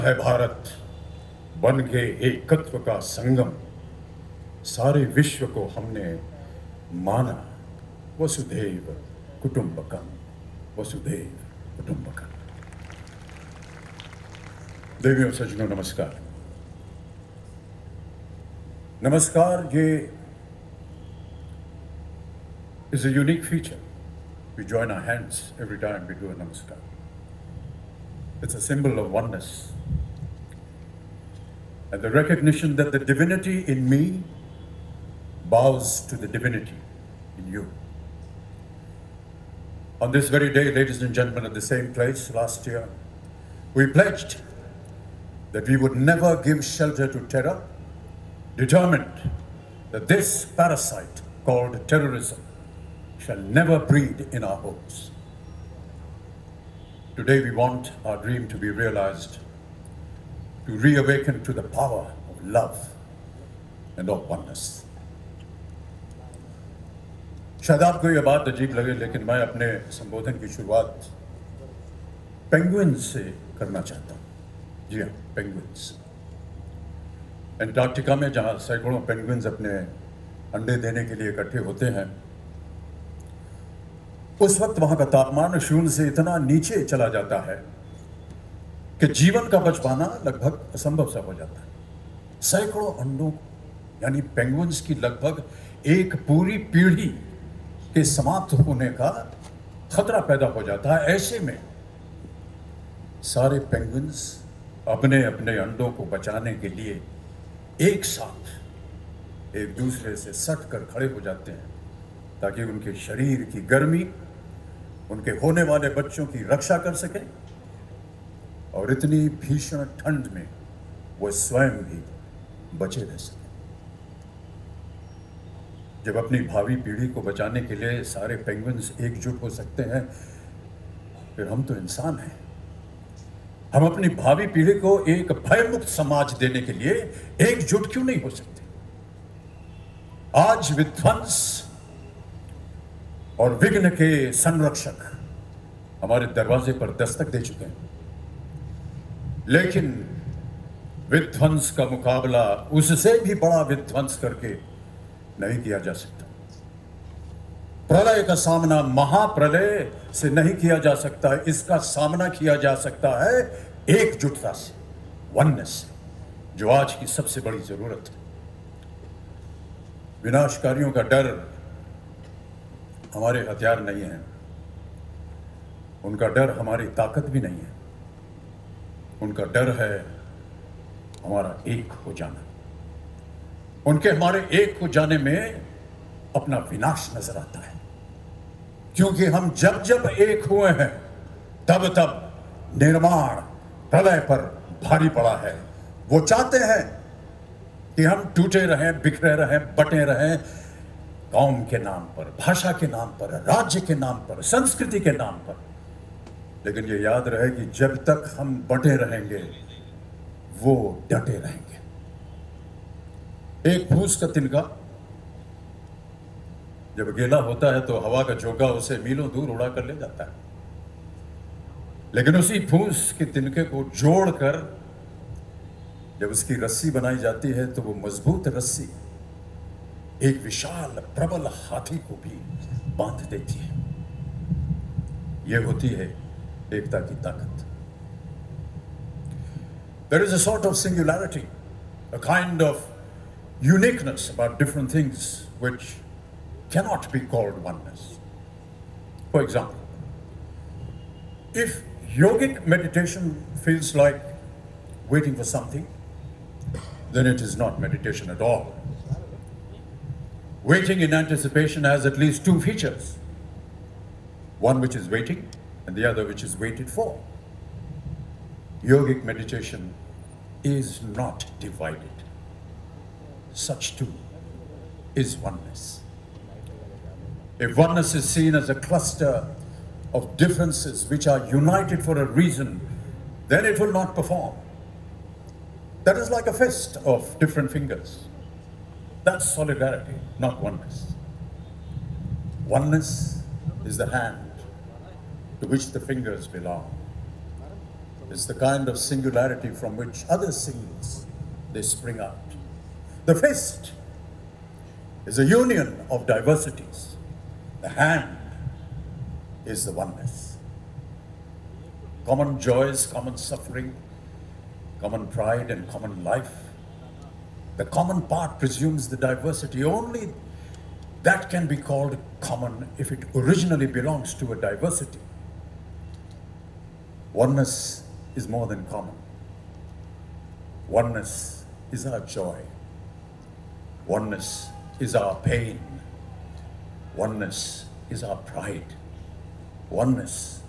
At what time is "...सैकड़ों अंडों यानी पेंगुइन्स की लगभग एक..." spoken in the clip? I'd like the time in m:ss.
1:32.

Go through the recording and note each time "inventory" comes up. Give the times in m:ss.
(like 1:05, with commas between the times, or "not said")
not said.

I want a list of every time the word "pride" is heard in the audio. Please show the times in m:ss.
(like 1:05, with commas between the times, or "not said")
5:15, 5:38.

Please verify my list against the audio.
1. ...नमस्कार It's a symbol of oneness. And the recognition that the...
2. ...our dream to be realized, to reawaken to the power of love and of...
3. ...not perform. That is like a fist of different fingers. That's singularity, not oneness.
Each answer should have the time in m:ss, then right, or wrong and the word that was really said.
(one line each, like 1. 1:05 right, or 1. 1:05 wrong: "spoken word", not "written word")
1. 0:26 right
2. 0:58 right
3. 4:43 wrong: "solidarity", not "singularity".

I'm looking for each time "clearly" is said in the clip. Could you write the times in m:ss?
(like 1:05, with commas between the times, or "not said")
not said.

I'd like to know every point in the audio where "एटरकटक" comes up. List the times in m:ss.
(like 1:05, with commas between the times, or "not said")
1:17.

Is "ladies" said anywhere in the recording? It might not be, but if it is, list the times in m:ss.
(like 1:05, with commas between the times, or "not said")
0:40.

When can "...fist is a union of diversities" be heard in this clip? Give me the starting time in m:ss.
5:03.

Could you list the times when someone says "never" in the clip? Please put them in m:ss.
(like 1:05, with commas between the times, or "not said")
0:45, 0:53.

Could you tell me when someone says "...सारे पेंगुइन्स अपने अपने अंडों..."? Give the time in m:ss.
1:43.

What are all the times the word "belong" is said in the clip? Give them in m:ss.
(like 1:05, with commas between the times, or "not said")
4:56, 5:23.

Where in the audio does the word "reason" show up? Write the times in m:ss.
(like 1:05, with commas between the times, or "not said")
4:42.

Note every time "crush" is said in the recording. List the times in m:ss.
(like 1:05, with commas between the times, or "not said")
not said.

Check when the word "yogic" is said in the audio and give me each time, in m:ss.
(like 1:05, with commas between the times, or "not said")
4:12, 4:28.